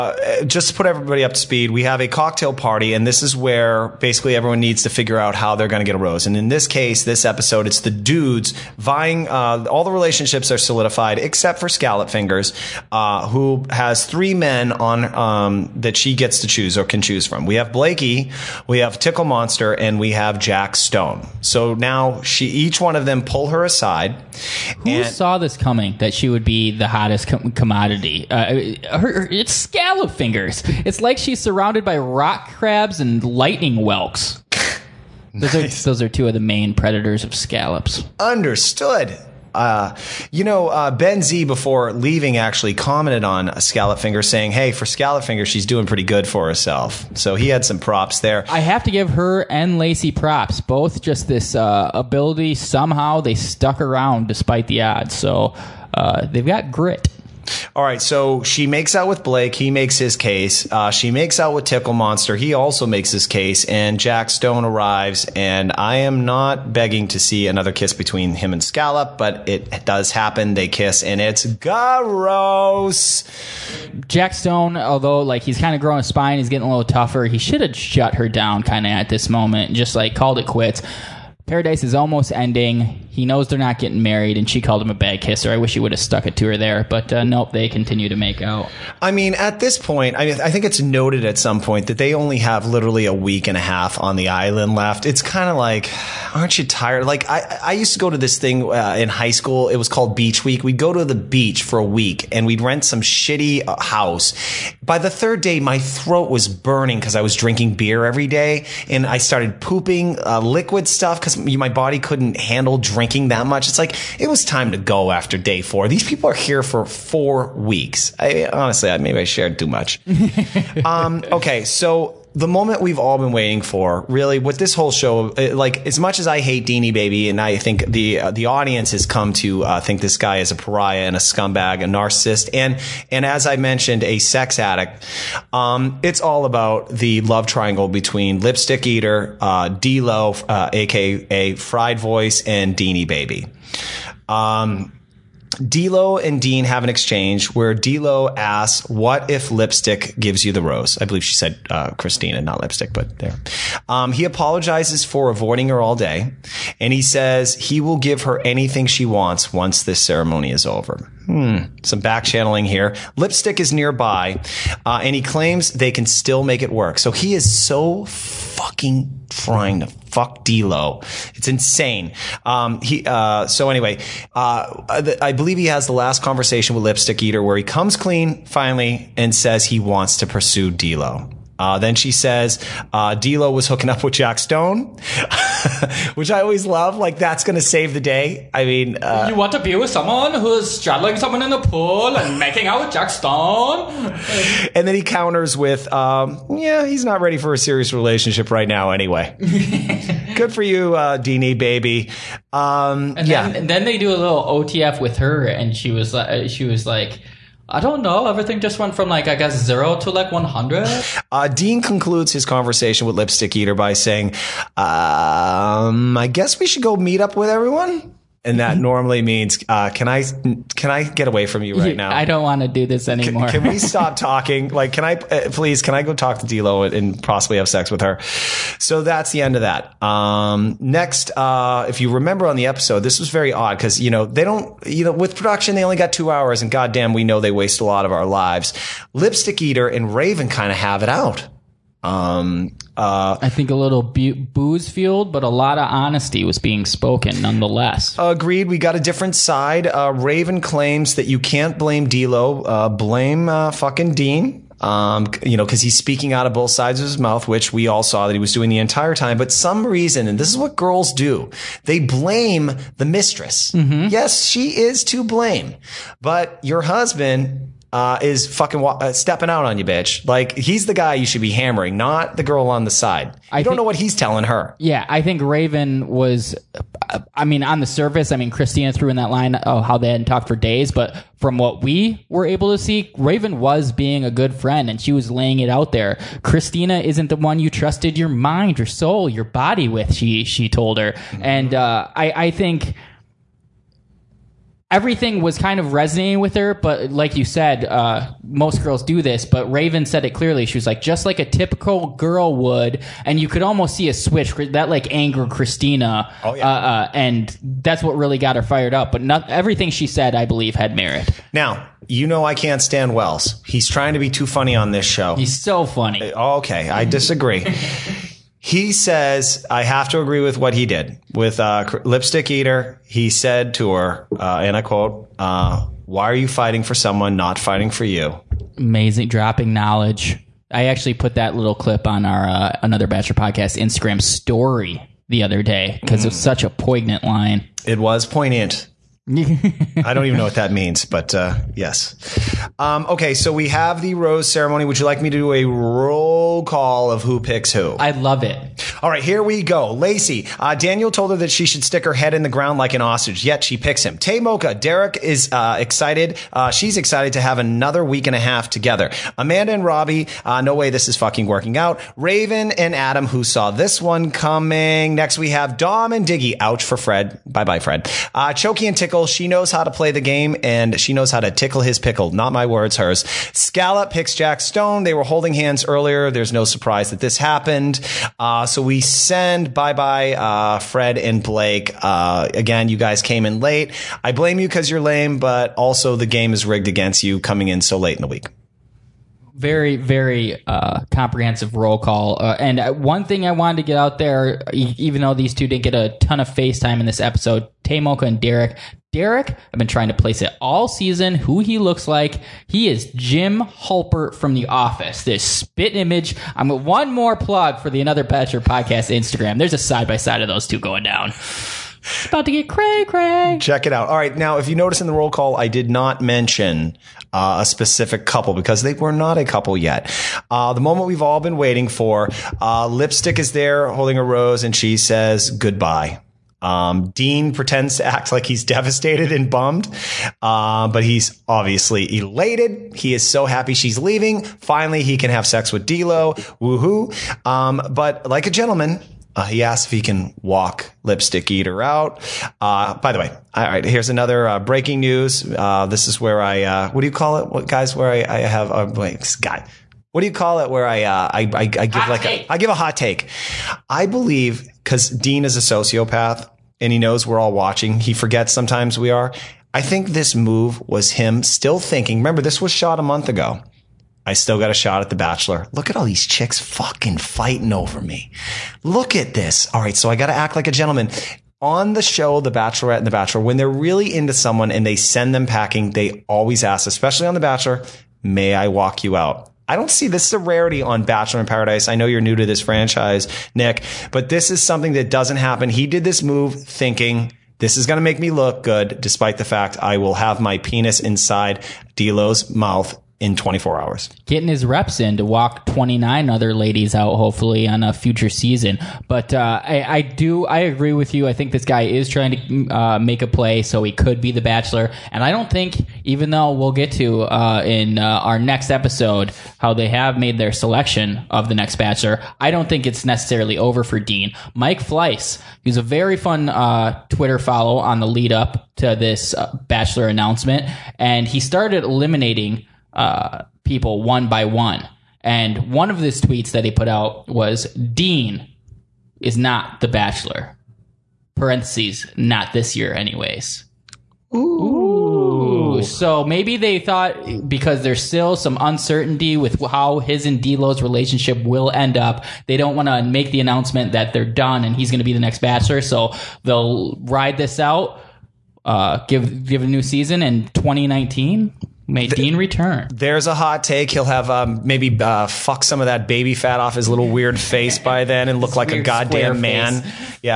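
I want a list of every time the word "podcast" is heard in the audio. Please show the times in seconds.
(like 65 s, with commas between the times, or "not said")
333 s, 408 s.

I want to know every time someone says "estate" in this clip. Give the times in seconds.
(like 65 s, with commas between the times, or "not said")
not said.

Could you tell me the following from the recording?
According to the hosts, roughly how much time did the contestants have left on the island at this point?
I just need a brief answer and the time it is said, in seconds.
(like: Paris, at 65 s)
a week and a half, at 93 s.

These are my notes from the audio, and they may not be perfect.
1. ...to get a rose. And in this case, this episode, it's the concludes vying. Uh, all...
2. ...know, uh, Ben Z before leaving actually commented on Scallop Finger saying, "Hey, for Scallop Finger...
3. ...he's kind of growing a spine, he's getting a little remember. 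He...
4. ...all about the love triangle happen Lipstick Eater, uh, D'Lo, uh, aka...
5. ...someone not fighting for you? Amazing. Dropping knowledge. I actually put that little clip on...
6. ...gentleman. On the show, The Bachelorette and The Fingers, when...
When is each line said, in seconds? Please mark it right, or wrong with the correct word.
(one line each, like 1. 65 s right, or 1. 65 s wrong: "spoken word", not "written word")
1. 5 s wrong: "dudes", not "concludes"
2. 40 s right
3. 75 s wrong: "tougher", not "remember"
4. 136 s wrong: "between", not "happen"
5. 326 s right
6. 470 s wrong: "Bachelor", not "Fingers".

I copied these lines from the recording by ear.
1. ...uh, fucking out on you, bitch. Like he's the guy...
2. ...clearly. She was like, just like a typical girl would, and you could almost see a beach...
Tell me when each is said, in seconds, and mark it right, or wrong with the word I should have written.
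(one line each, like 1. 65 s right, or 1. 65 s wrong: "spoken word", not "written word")
1. 269 s wrong: "stepping", not "fucking"
2. 300 s wrong: "switch", not "beach".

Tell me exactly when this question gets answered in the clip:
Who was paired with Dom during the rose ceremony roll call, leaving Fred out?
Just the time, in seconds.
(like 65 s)
366 s.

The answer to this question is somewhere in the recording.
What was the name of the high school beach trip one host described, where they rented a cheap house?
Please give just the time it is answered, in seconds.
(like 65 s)
100 s.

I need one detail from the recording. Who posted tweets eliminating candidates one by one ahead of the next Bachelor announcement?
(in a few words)
Mike Fleiss.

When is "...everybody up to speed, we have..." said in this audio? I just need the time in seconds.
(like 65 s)
0 s.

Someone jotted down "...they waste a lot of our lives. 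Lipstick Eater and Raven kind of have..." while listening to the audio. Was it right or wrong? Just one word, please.
right.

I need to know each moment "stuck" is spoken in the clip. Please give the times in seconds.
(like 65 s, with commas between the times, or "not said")
53 s, 85 s.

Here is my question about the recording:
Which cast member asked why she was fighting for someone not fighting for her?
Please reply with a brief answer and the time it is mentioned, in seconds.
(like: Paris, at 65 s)
Wells, at 313 s.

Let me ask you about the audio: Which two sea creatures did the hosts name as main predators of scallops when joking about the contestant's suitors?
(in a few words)
rock crabs and lightning whelks.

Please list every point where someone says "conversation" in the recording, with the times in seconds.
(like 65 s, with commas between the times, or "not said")
176 s, 212 s.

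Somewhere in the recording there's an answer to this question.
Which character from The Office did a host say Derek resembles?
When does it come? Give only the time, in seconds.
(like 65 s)
403 s.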